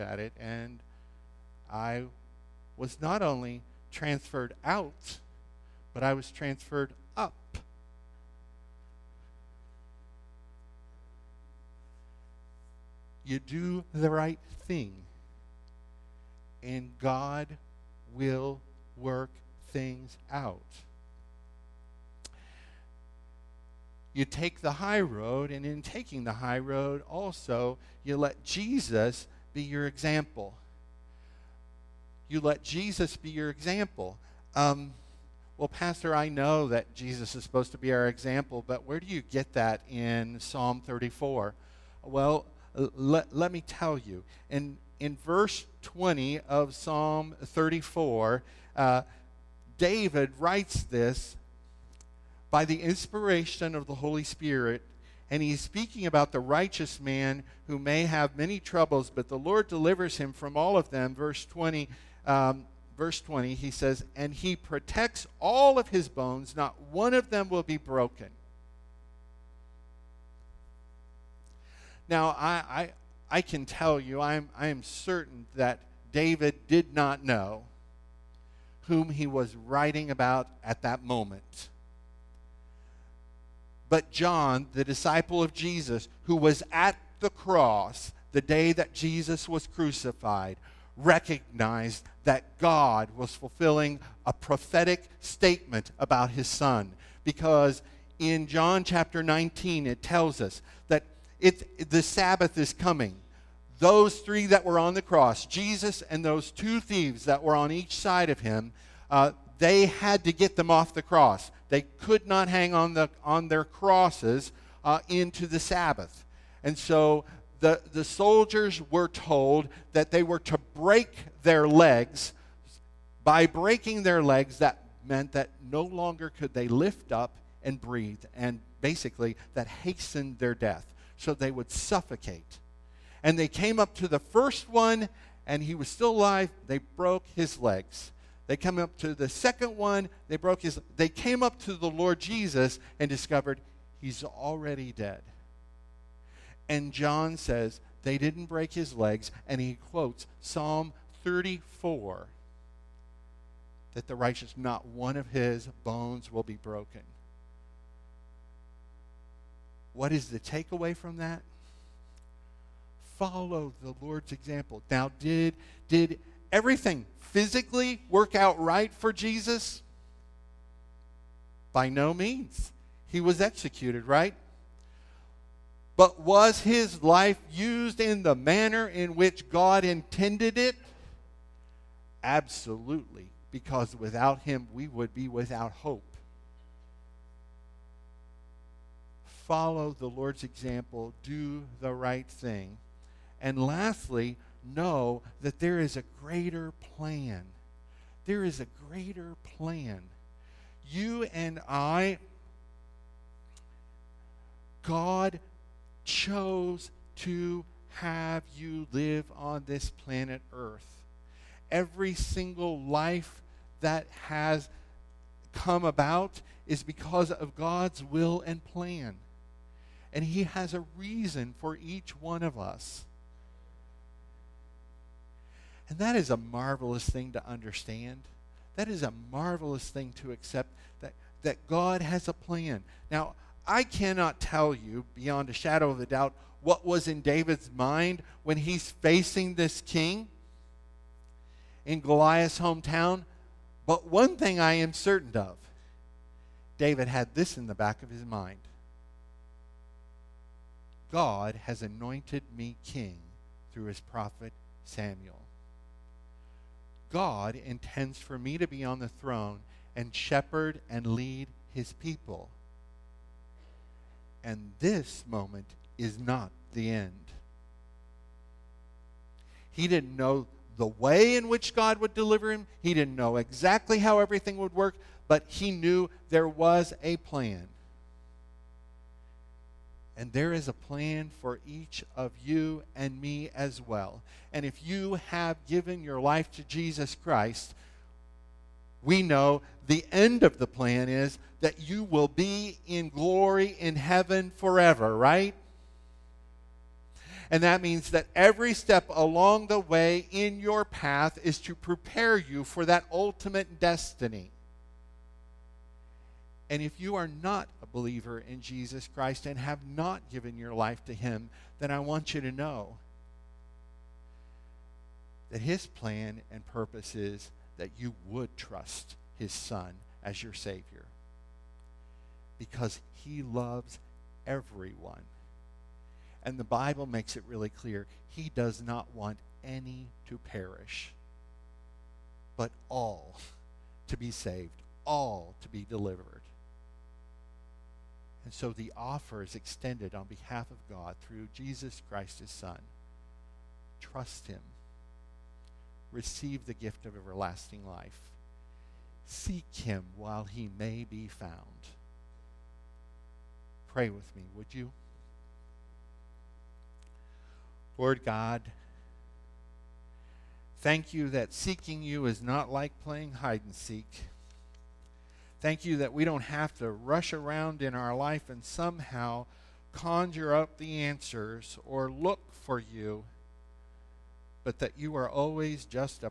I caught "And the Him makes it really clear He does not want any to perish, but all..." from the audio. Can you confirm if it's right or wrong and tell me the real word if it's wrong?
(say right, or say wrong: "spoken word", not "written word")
wrong: "Bible", not "Him".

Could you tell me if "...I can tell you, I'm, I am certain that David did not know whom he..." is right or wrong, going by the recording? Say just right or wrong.
right.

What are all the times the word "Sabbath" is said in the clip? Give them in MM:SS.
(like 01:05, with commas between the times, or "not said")
01:42, 01:55.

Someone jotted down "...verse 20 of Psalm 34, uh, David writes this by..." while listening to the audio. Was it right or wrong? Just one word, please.
right.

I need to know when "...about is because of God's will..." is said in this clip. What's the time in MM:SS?
03:35.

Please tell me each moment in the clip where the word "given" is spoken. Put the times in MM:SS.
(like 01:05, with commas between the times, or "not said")
04:45, 05:10.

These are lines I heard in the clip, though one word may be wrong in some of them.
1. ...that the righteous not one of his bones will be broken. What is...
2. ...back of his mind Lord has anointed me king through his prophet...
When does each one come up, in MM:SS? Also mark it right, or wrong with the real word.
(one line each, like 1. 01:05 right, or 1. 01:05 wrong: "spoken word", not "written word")
1. 02:33 right
2. 04:07 wrong: "God", not "Lord".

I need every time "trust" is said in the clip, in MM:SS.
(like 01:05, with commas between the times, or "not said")
05:18, 05:44.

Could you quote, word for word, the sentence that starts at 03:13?
And lastly, know that there is a greater plan.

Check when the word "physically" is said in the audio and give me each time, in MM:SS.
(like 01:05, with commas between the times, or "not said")
02:47.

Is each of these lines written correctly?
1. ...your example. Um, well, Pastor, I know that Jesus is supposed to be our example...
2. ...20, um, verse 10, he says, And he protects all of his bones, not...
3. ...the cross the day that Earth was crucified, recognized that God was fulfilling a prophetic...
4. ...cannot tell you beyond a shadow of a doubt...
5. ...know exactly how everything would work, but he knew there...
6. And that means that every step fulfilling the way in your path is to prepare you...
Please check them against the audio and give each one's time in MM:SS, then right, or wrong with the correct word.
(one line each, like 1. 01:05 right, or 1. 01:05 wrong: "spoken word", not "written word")
1. 00:33 right
2. 01:01 wrong: "20", not "10"
3. 01:27 wrong: "Jesus", not "Earth"
4. 03:53 right
5. 04:33 right
6. 04:57 wrong: "along", not "fulfilling".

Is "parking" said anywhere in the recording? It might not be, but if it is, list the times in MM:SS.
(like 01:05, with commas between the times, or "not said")
not said.